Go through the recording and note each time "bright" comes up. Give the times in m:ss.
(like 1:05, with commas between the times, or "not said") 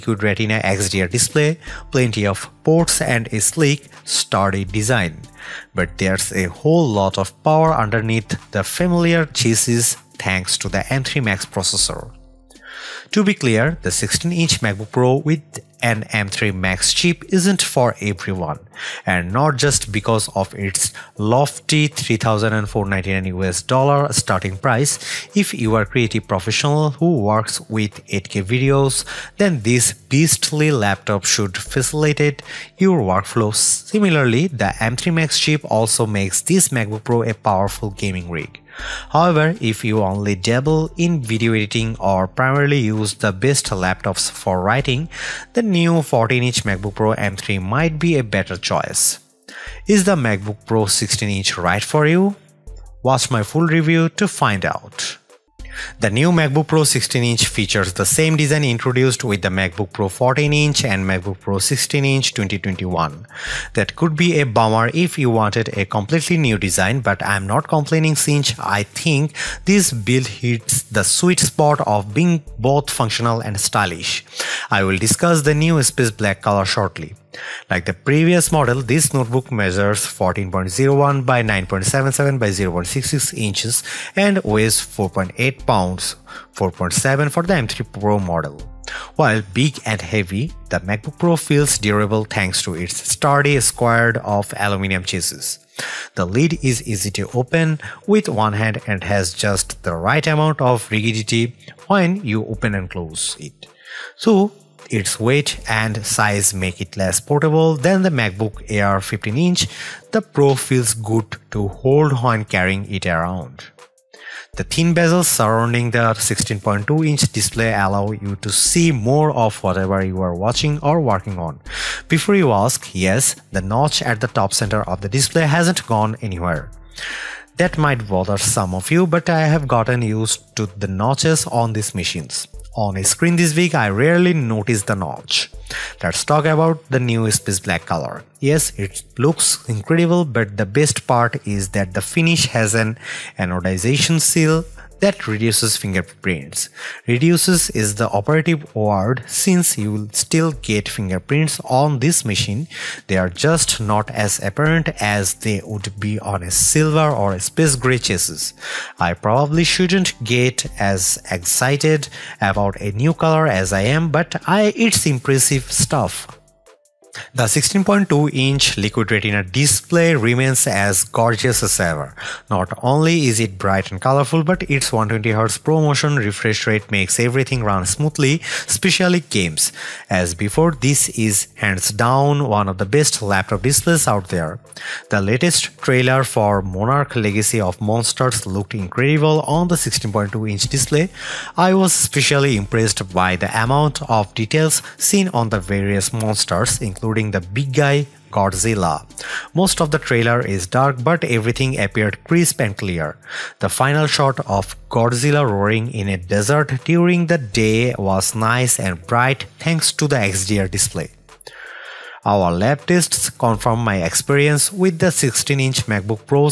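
2:53, 3:29.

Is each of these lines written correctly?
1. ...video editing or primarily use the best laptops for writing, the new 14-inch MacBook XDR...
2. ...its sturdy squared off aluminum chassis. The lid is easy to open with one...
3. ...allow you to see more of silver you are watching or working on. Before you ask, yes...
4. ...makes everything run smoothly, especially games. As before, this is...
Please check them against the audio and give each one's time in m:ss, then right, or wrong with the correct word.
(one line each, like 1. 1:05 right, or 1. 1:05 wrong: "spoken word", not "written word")
1. 0:41 wrong: "Pro", not "XDR"
2. 1:32 right
3. 1:57 wrong: "whatever", not "silver"
4. 2:56 right.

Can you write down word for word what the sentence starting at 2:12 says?
On a screen this week, I rarely notice the notch.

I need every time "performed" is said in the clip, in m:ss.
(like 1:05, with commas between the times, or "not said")
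not said.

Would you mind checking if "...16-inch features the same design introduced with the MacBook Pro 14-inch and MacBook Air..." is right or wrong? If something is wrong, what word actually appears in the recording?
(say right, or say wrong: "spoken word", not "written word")
wrong: "Pro", not "Air".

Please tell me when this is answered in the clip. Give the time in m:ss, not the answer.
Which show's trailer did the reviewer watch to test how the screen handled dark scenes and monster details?
3:06.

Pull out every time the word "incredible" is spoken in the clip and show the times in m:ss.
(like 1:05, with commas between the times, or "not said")
2:19, 3:08.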